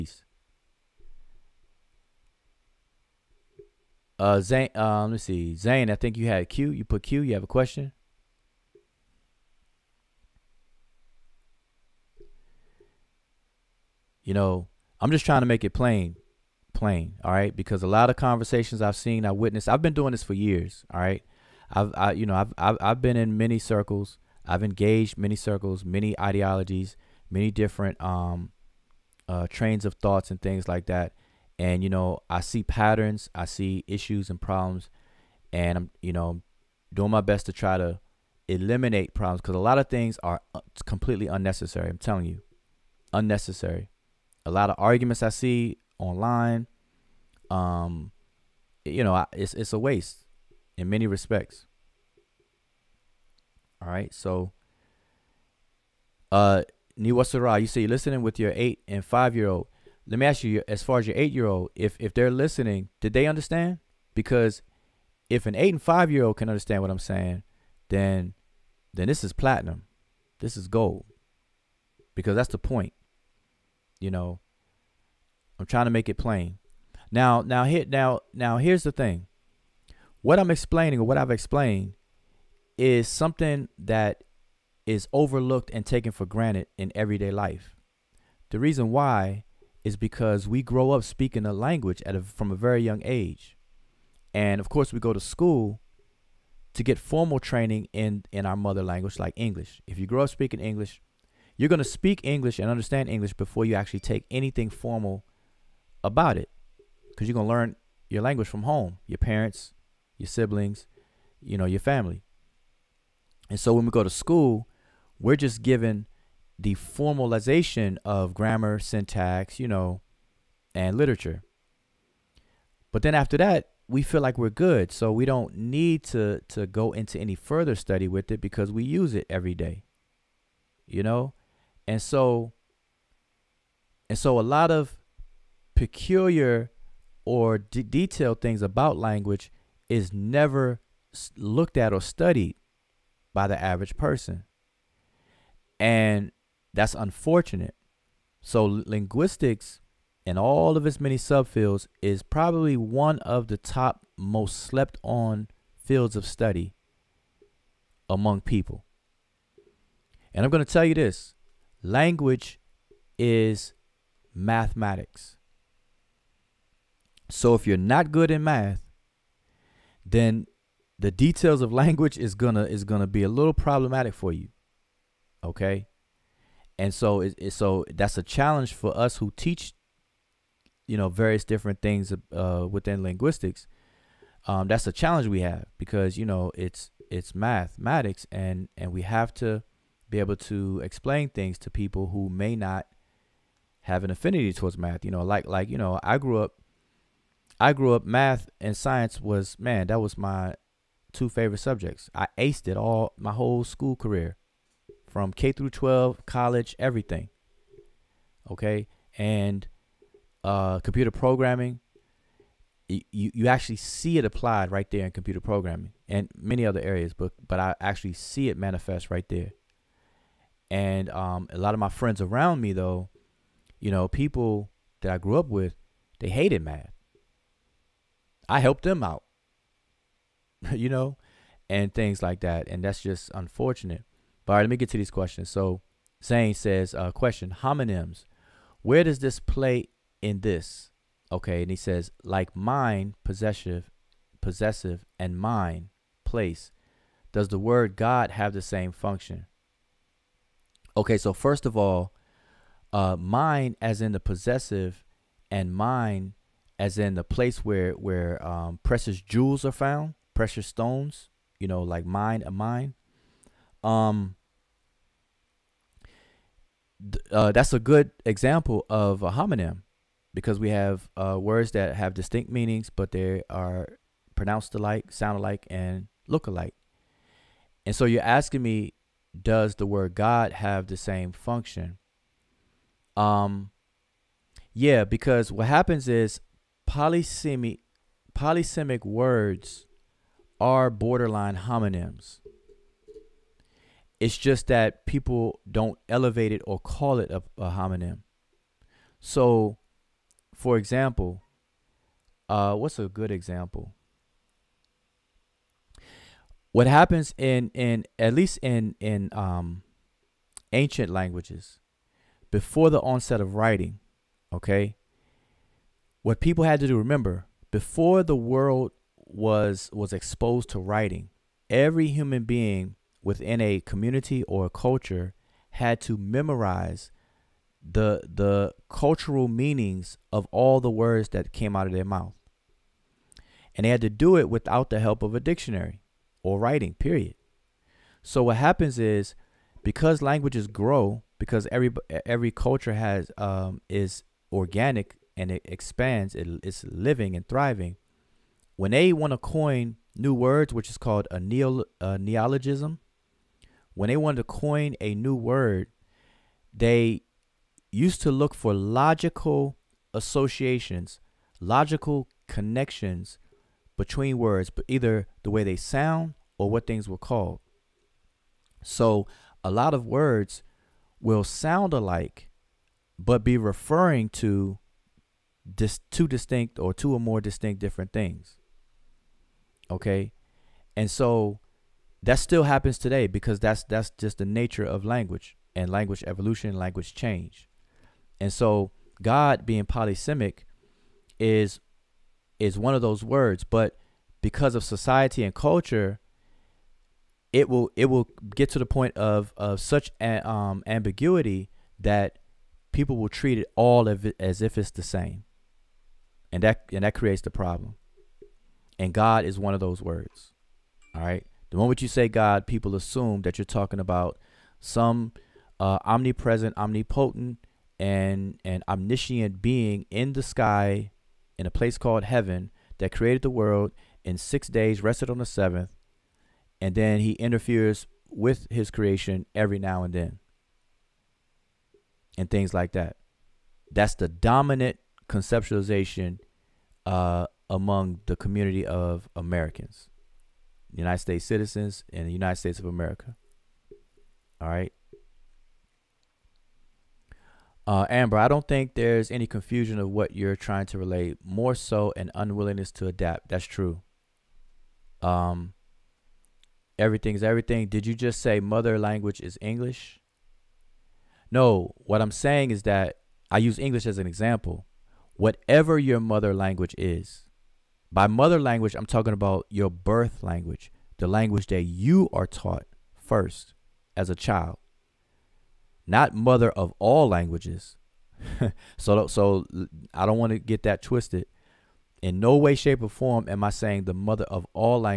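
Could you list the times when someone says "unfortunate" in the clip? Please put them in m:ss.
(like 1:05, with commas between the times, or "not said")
2:26, 3:53.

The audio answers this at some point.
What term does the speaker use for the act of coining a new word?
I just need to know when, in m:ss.
5:52.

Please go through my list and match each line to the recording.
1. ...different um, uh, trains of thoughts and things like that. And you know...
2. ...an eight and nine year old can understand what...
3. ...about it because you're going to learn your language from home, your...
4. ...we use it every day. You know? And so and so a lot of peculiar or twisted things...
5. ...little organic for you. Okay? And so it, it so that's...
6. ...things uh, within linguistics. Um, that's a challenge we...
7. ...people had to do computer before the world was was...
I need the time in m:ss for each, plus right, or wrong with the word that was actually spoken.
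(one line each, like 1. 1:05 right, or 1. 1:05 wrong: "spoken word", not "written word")
1. 0:27 right
2. 1:05 wrong: "five", not "nine"
3. 1:46 right
4. 2:08 wrong: "detailed", not "twisted"
5. 2:53 wrong: "problematic", not "organic"
6. 3:01 right
7. 5:16 wrong: "remember", not "computer".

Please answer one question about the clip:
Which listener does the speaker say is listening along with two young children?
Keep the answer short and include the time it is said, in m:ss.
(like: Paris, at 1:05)
Niwasara, at 0:56.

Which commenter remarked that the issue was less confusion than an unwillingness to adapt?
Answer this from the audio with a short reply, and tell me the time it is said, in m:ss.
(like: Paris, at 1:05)
Amber, at 7:28.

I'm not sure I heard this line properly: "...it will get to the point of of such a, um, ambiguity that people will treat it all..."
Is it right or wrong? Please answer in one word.
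right.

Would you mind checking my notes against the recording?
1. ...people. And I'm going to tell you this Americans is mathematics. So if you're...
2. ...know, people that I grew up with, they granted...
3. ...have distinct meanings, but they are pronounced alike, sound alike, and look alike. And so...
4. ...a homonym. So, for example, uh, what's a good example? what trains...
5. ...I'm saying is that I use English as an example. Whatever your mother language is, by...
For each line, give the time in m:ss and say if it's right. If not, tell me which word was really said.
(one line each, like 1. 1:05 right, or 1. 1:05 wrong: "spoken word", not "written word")
1. 2:38 wrong: "Language", not "Americans"
2. 3:43 wrong: "hated", not "granted"
3. 4:31 right
4. 4:57 wrong: "happens", not "trains"
5. 7:42 right.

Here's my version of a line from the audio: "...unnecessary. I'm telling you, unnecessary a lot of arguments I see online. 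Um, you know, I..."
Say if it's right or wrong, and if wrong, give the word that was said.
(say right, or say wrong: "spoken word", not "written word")
right.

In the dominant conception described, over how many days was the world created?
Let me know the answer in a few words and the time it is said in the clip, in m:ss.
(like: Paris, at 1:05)
6, at 7:04.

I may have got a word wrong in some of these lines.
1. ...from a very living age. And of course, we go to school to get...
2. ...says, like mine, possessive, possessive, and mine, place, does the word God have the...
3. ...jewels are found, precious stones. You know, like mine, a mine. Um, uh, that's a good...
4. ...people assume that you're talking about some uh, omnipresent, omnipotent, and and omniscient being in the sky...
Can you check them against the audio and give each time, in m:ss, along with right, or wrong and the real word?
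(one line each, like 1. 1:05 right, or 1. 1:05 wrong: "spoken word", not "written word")
1. 1:32 wrong: "young", not "living"
2. 4:01 right
3. 4:19 right
4. 6:52 right.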